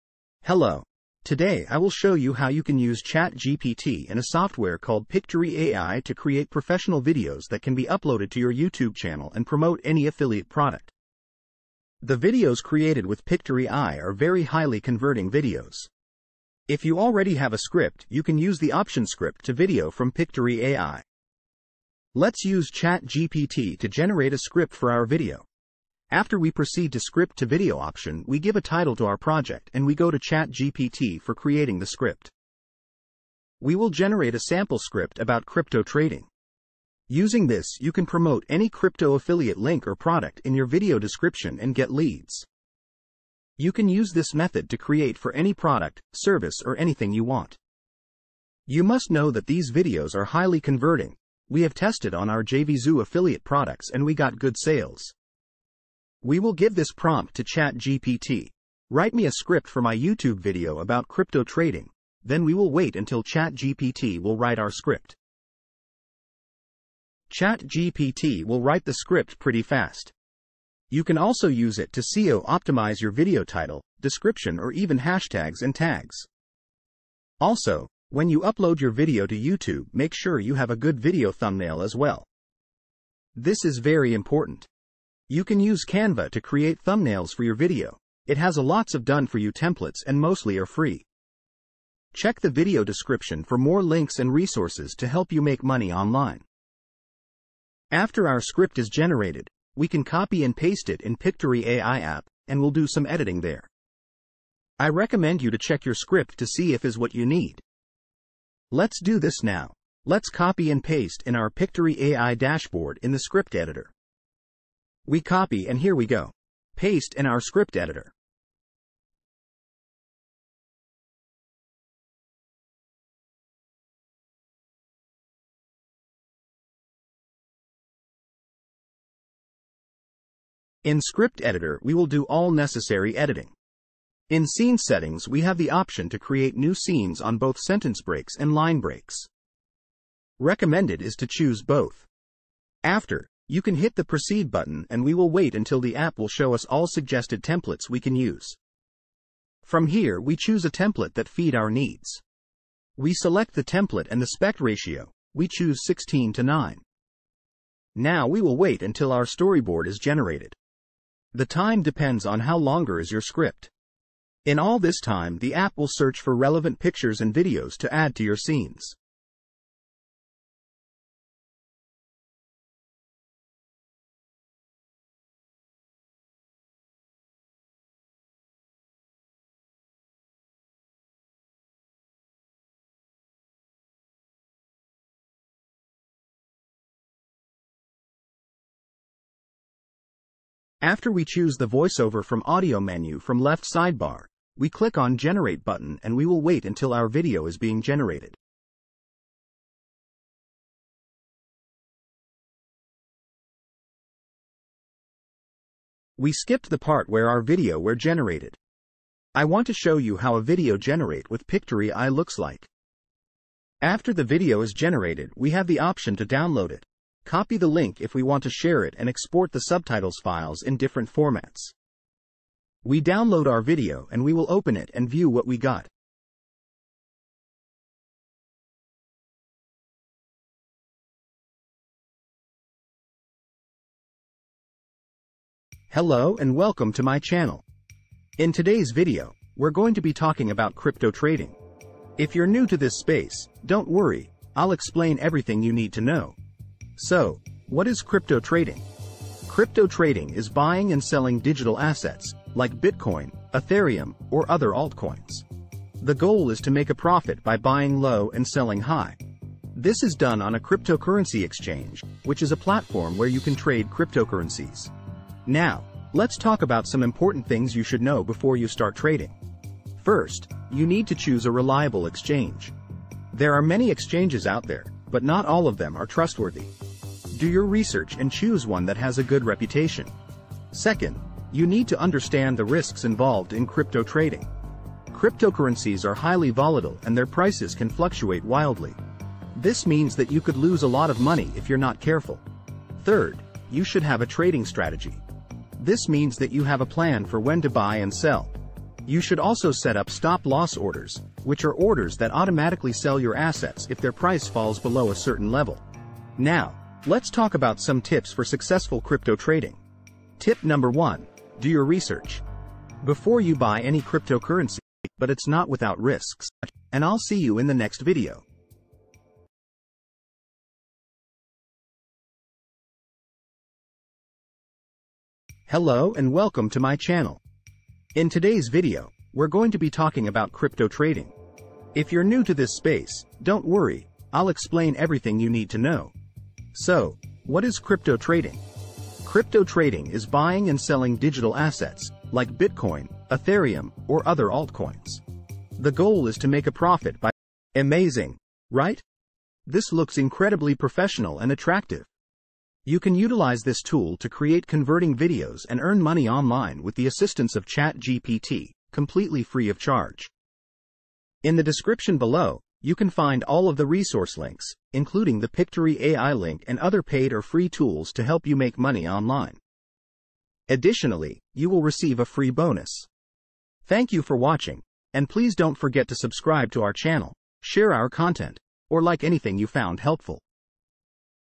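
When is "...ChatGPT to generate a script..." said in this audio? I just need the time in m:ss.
0:22.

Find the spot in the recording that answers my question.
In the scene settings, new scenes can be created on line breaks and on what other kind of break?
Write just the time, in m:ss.
2:17.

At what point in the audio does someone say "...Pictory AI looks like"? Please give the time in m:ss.
3:31.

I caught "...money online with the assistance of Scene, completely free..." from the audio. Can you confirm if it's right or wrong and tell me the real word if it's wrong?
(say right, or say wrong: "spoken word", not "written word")
wrong: "ChatGPT", not "Scene".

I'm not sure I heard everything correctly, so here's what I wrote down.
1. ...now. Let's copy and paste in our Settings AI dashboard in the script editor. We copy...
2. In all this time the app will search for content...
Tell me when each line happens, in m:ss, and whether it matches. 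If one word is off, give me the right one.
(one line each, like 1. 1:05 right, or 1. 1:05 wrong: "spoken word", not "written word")
1. 1:49 wrong: "Pictory", not "Settings"
2. 2:44 wrong: "relevant", not "content".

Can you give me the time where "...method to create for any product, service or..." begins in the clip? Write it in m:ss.
0:44.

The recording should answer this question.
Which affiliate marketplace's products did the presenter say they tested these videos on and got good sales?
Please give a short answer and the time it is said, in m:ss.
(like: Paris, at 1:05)
JVZoo, at 0:52.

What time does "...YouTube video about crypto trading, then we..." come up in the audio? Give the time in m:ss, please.
0:59.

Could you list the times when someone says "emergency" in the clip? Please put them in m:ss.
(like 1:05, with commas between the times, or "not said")
not said.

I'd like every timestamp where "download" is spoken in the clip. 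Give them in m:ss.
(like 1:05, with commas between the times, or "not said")
3:36, 3:43.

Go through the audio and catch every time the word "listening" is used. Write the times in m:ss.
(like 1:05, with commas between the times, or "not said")
not said.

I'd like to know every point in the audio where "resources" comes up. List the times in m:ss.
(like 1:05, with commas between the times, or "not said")
1:34, 6:03.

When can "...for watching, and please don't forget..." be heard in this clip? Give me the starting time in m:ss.
6:14.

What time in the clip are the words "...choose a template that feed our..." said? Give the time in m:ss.
2:30.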